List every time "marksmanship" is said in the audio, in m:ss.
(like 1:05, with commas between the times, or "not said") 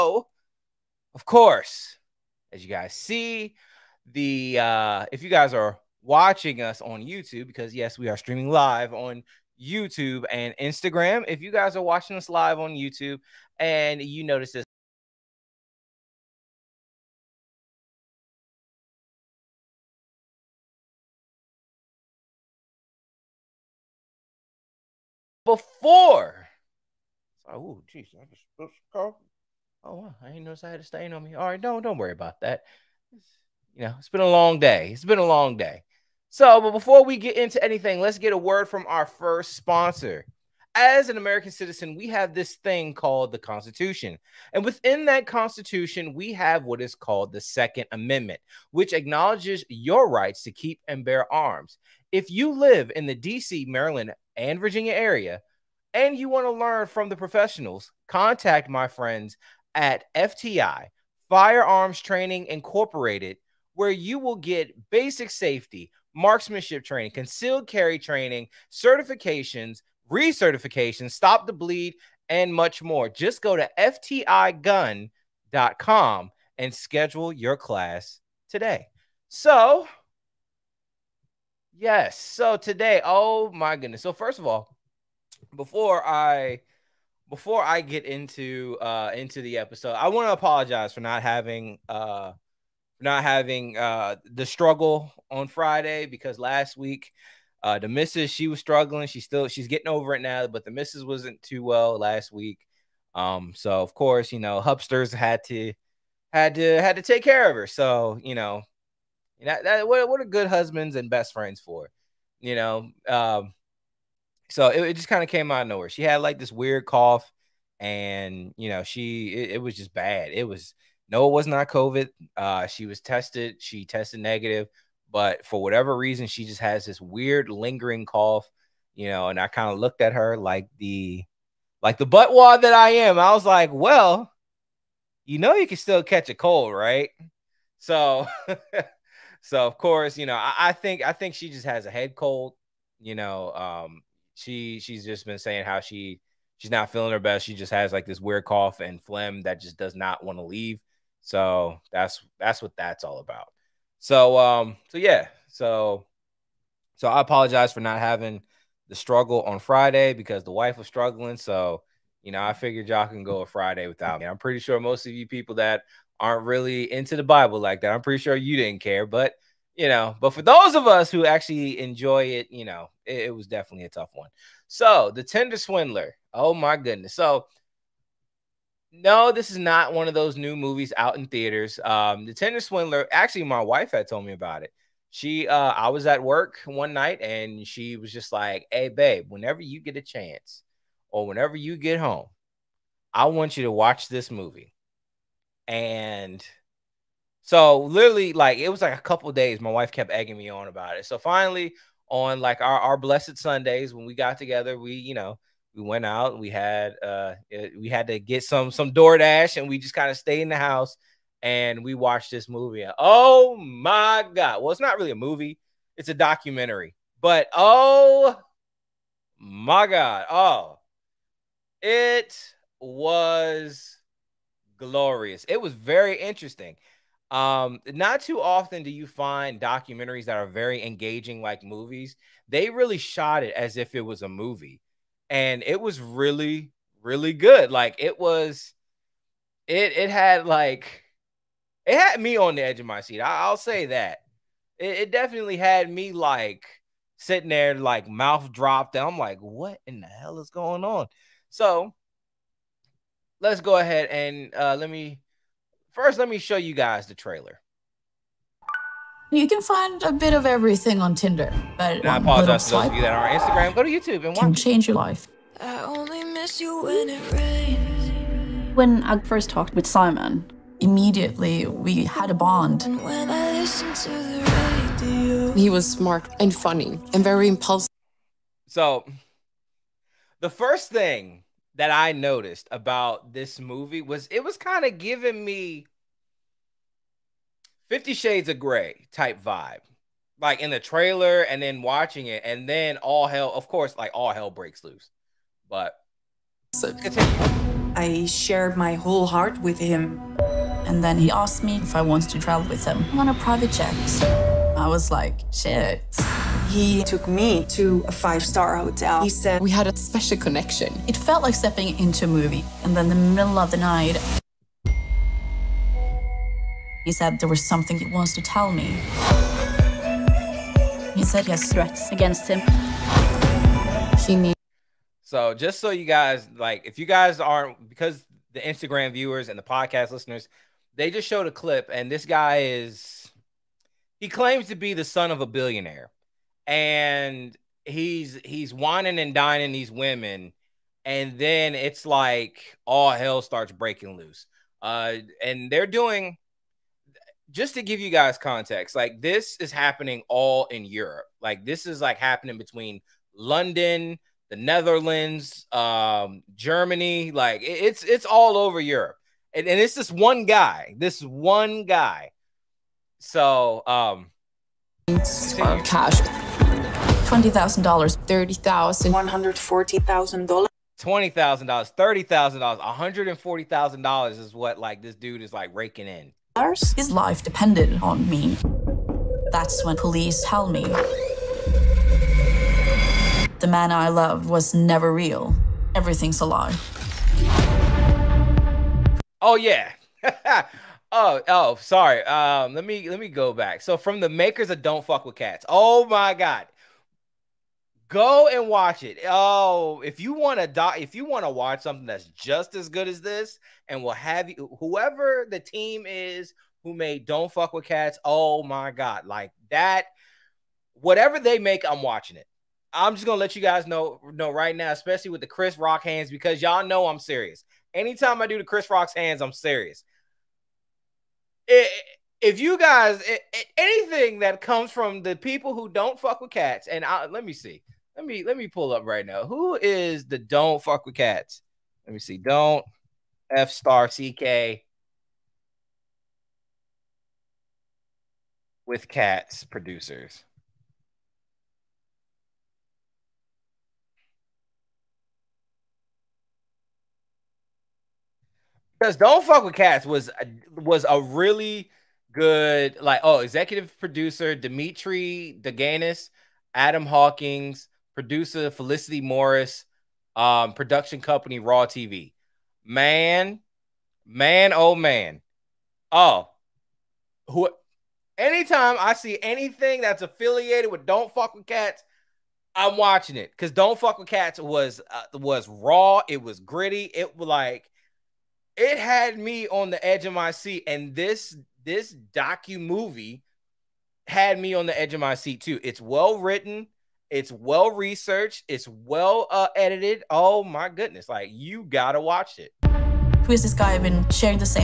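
1:06.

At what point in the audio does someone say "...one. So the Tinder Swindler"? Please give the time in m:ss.
2:54.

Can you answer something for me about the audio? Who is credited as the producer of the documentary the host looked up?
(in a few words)
Felicity Morris.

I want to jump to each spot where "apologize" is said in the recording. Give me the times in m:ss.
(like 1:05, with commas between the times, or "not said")
1:30, 2:37, 4:22.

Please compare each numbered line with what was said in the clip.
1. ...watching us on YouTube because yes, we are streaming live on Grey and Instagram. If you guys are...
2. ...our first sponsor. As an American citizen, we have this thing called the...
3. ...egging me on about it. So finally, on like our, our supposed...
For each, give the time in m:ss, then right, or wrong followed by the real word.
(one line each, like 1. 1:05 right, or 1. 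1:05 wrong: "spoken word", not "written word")
1. 0:06 wrong: "YouTube", not "Grey"
2. 0:38 right
3. 3:20 wrong: "blessed", not "supposed".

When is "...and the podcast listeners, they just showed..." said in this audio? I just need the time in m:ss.
5:29.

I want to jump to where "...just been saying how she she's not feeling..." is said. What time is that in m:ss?
2:25.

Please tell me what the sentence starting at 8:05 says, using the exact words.
It's well written, it's well researched, it's well uh, edited.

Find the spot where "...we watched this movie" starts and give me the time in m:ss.
3:31.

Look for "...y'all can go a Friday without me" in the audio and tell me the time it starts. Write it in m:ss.
2:42.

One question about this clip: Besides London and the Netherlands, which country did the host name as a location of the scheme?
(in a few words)
Germany.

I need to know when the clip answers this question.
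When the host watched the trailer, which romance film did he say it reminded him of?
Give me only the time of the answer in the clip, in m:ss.
4:47.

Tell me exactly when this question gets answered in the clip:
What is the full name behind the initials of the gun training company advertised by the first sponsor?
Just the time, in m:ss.
1:01.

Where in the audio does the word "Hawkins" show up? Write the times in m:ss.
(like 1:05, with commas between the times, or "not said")
7:37.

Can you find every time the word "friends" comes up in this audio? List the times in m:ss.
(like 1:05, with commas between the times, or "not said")
0:58, 1:51.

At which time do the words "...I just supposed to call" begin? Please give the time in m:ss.
0:28.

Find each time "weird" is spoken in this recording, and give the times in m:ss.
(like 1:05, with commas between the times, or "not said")
1:56, 2:07, 2:28.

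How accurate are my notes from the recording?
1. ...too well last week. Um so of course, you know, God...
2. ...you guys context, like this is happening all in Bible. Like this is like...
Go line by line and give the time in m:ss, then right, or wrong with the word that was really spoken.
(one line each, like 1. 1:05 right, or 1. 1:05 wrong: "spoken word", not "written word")
1. 1:41 wrong: "Hubsters", not "God"
2. 5:47 wrong: "Europe", not "Bible".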